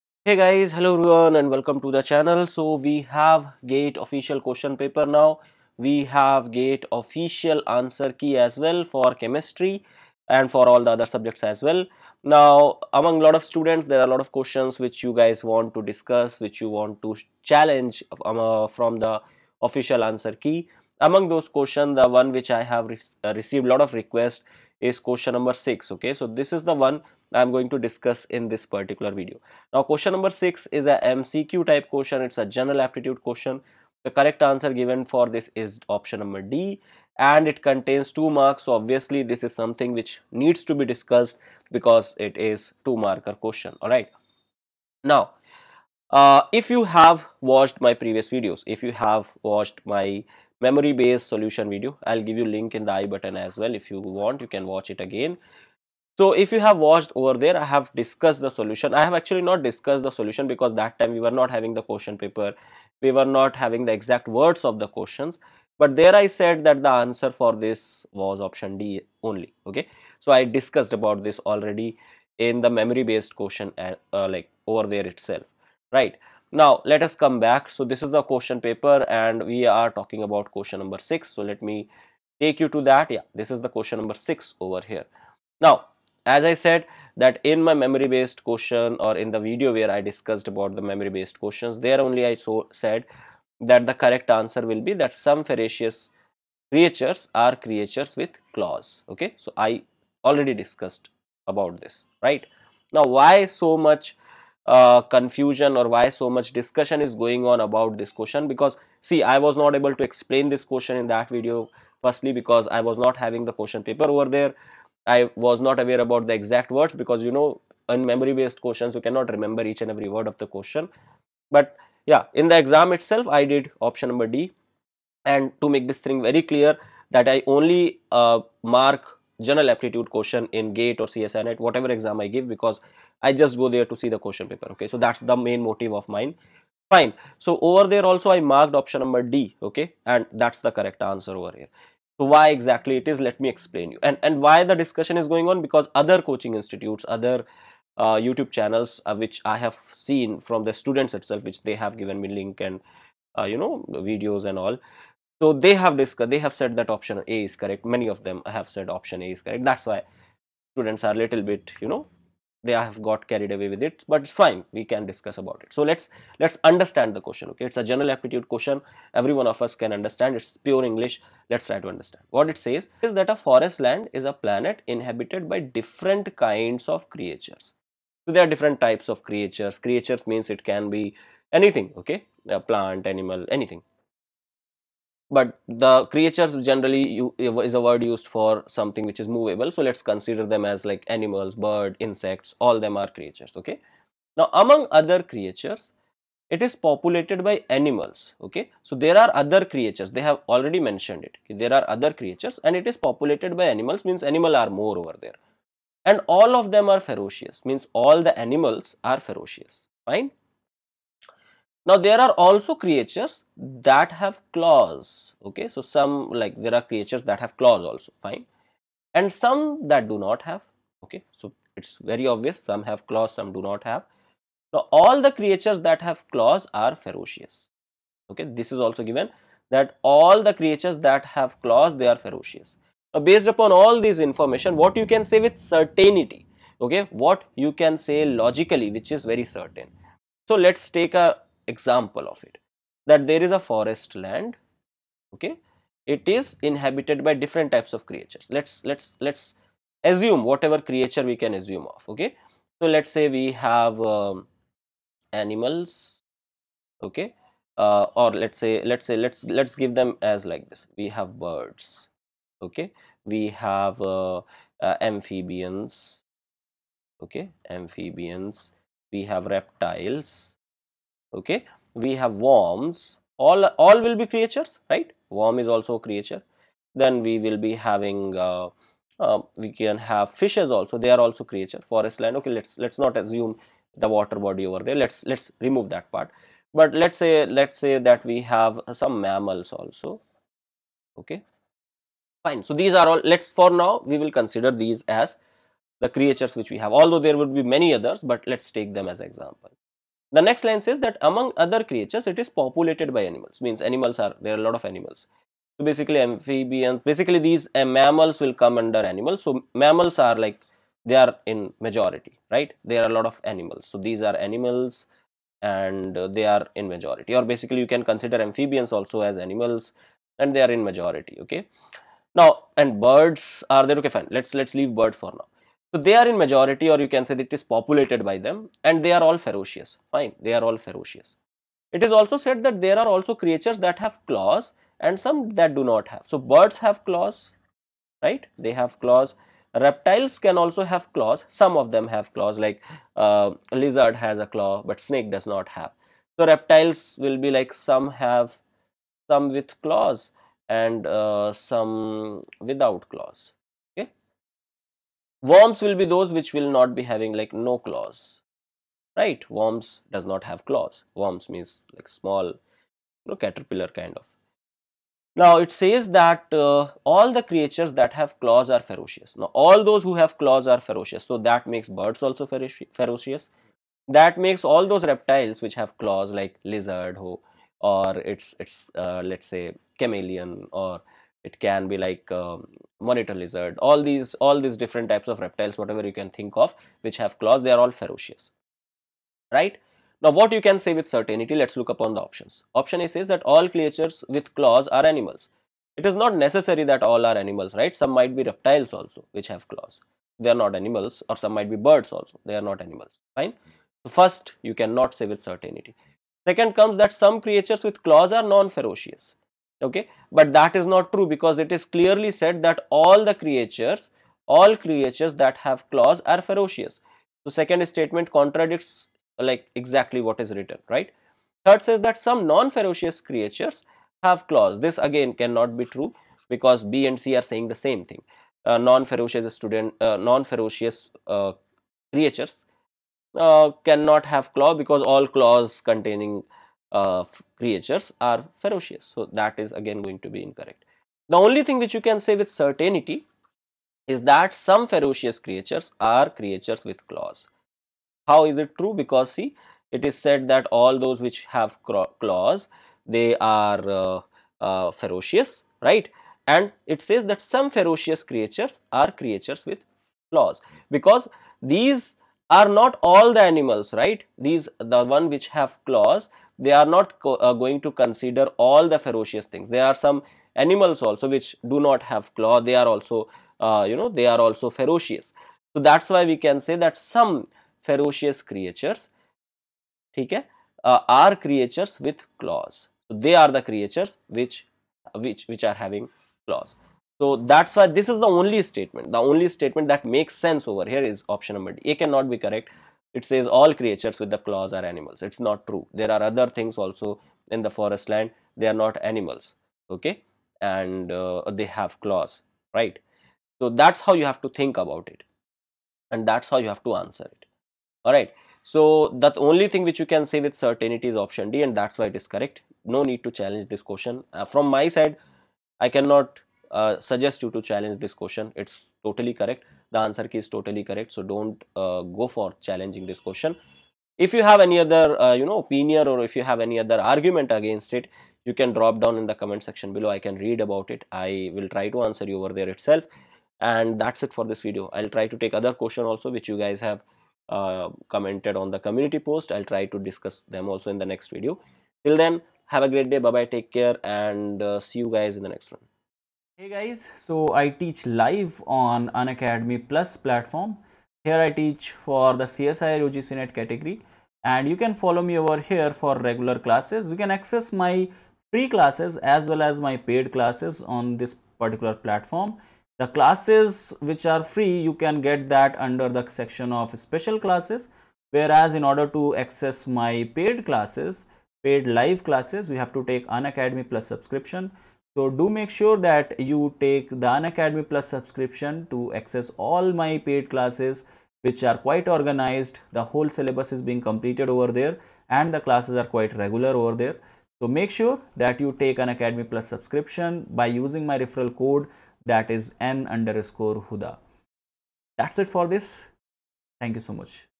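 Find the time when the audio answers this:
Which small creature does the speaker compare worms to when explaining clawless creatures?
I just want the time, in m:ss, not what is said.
6:03.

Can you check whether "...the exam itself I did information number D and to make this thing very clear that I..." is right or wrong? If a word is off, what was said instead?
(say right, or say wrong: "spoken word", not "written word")
wrong: "option", not "information".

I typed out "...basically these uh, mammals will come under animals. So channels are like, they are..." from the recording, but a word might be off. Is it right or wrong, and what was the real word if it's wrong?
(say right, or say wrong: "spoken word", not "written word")
wrong: "mammals", not "channels".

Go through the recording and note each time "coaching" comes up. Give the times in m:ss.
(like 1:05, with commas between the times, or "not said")
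2:26.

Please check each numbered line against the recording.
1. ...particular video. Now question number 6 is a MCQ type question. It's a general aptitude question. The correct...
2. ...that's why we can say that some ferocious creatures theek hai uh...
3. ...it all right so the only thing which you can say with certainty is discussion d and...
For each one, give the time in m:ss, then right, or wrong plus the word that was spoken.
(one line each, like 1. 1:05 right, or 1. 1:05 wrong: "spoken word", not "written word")
1. 0:28 right
2. 7:55 right
3. 8:27 wrong: "option", not "discussion".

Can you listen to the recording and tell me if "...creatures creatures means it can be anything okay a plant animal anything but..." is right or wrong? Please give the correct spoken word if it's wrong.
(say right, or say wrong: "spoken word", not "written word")
right.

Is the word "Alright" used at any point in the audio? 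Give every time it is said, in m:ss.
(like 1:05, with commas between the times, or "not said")
0:43.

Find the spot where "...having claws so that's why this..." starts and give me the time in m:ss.
8:05.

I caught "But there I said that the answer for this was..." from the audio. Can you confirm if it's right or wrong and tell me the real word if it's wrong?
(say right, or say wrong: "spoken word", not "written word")
right.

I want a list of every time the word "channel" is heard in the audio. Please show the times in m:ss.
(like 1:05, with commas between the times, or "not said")
0:02, 2:28.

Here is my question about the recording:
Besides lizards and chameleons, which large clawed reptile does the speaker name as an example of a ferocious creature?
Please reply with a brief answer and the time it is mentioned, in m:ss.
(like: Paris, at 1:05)
monitor lizard, at 6:22.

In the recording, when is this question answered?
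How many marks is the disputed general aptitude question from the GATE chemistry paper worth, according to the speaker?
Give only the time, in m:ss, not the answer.
0:38.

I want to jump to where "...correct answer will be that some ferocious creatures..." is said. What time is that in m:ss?
1:33.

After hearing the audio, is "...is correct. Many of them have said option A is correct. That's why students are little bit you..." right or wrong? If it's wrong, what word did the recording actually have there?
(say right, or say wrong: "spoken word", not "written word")
right.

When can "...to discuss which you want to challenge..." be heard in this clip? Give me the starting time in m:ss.
0:15.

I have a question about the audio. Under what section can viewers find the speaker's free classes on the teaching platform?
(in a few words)
special classes.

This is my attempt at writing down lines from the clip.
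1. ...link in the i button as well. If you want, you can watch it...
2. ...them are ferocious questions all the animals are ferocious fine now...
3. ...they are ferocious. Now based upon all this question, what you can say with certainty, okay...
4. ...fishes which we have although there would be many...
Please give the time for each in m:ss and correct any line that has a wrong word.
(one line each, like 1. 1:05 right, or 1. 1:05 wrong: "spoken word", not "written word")
1. 0:52 right
2. 3:26 wrong: "means", not "questions"
3. 3:51 wrong: "information", not "question"
4. 4:56 wrong: "creatures", not "fishes".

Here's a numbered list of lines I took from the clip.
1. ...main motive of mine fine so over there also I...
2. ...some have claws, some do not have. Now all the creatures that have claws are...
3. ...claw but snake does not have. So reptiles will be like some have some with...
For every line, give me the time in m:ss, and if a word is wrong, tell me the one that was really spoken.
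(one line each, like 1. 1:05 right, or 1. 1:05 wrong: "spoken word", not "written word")
1. 2:15 right
2. 3:42 right
3. 5:44 right.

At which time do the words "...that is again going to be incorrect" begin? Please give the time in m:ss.
7:19.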